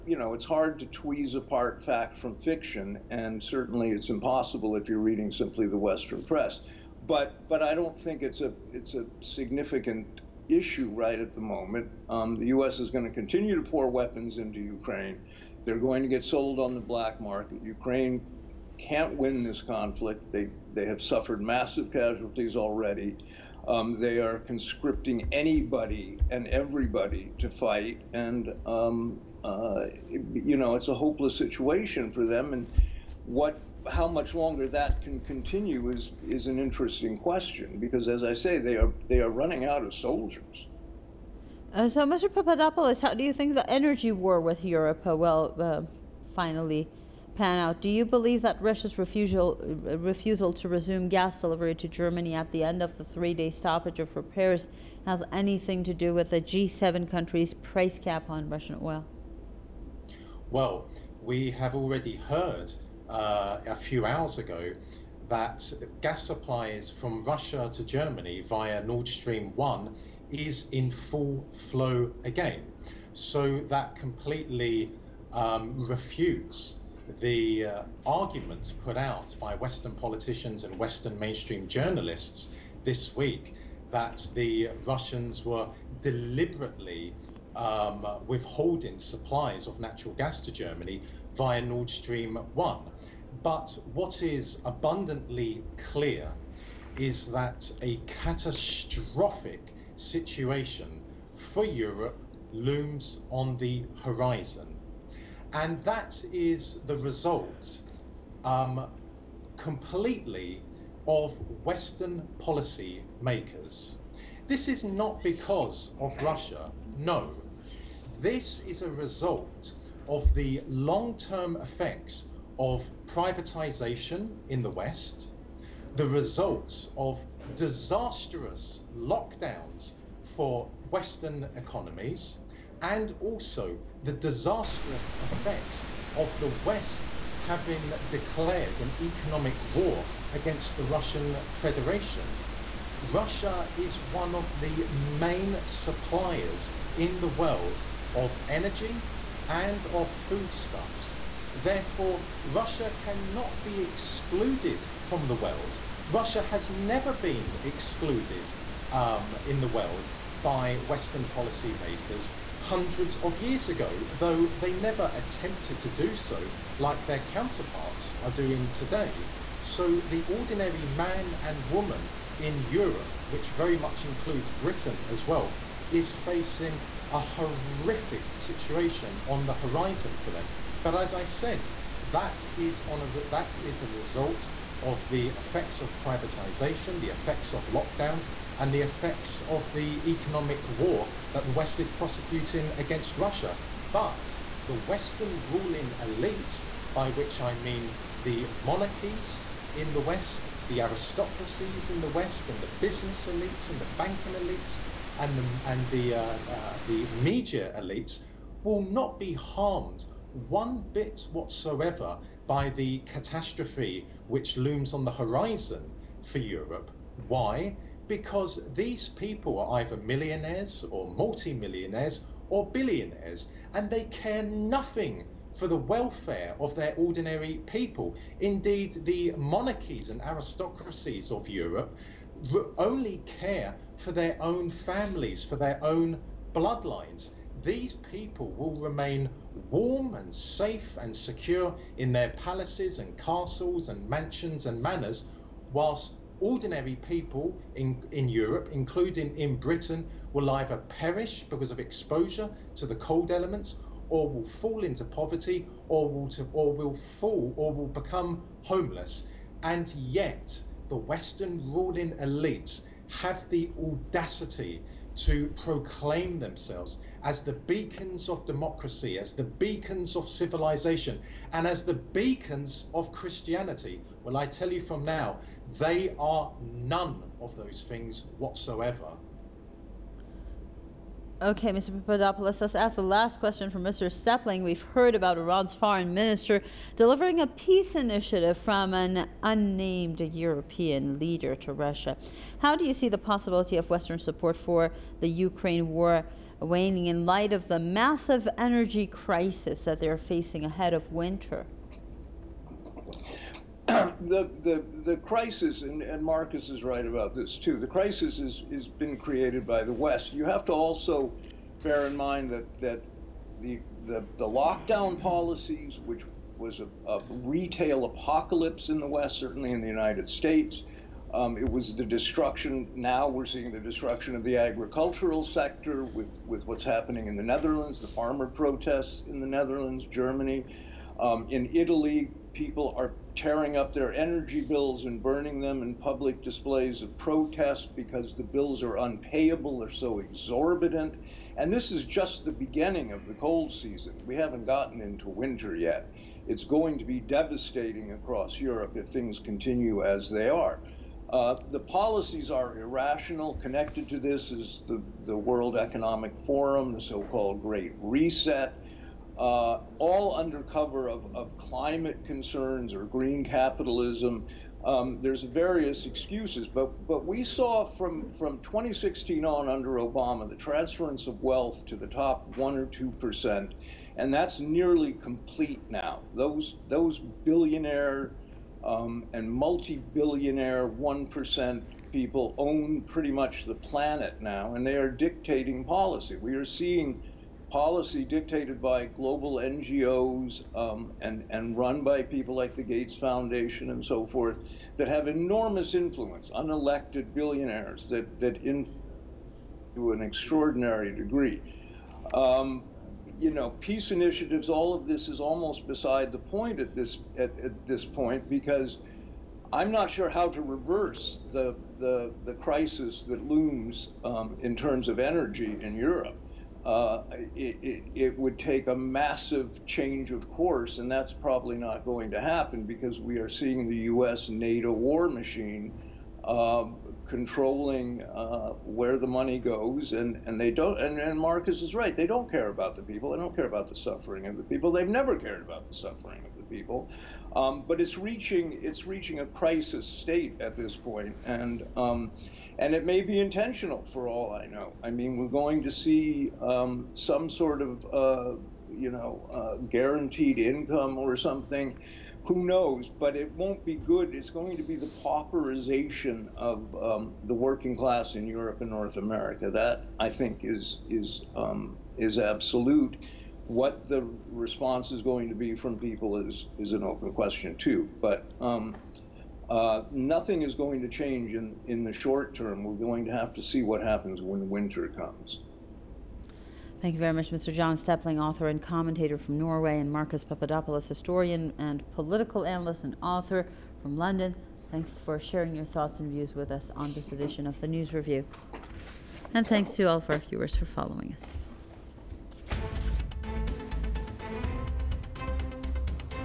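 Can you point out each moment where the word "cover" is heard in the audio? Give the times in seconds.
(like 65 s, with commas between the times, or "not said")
360 s.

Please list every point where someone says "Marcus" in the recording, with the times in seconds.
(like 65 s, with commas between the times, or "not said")
306 s, 431 s, 480 s.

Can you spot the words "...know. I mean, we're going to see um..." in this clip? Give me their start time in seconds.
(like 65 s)
444 s.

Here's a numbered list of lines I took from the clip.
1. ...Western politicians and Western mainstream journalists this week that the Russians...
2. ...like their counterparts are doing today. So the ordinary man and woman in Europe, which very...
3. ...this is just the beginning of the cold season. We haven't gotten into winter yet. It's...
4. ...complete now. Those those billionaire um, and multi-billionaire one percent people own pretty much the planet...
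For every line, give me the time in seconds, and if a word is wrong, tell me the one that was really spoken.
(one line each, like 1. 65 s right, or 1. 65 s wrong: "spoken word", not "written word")
1. 79 s right
2. 166 s right
3. 341 s right
4. 375 s right.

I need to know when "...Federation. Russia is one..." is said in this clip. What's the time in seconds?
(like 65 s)
141 s.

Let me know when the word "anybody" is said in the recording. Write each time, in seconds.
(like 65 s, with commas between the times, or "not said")
25 s.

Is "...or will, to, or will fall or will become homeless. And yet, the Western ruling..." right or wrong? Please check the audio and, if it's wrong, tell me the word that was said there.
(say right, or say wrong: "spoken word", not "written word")
right.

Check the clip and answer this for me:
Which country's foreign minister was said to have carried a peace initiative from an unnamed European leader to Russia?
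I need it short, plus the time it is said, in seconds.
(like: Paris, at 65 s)
Iran, at 285 s.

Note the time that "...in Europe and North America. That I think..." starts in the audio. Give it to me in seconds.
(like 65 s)
458 s.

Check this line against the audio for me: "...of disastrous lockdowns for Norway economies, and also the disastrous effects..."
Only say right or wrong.
wrong.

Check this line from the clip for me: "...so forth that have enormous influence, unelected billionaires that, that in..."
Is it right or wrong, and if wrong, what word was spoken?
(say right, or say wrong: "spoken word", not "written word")
right.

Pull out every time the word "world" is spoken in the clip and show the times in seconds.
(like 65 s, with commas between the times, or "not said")
147 s, 155 s, 159 s, 355 s.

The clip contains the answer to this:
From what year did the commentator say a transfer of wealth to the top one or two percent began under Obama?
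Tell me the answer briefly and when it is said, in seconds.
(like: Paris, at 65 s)
2016, at 368 s.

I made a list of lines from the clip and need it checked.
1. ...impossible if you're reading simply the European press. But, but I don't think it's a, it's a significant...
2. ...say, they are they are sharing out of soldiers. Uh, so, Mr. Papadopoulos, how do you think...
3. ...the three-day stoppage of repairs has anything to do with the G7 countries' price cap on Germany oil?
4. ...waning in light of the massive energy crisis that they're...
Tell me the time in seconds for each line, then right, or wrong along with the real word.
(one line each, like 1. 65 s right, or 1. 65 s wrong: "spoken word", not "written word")
1. 4 s wrong: "Western", not "European"
2. 38 s wrong: "running", not "sharing"
3. 52 s wrong: "Russian", not "Germany"
4. 296 s right.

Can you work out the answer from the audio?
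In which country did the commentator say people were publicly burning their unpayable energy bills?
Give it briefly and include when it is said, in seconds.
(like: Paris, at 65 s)
Italy, at 331 s.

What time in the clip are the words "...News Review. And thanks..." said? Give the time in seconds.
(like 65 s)
487 s.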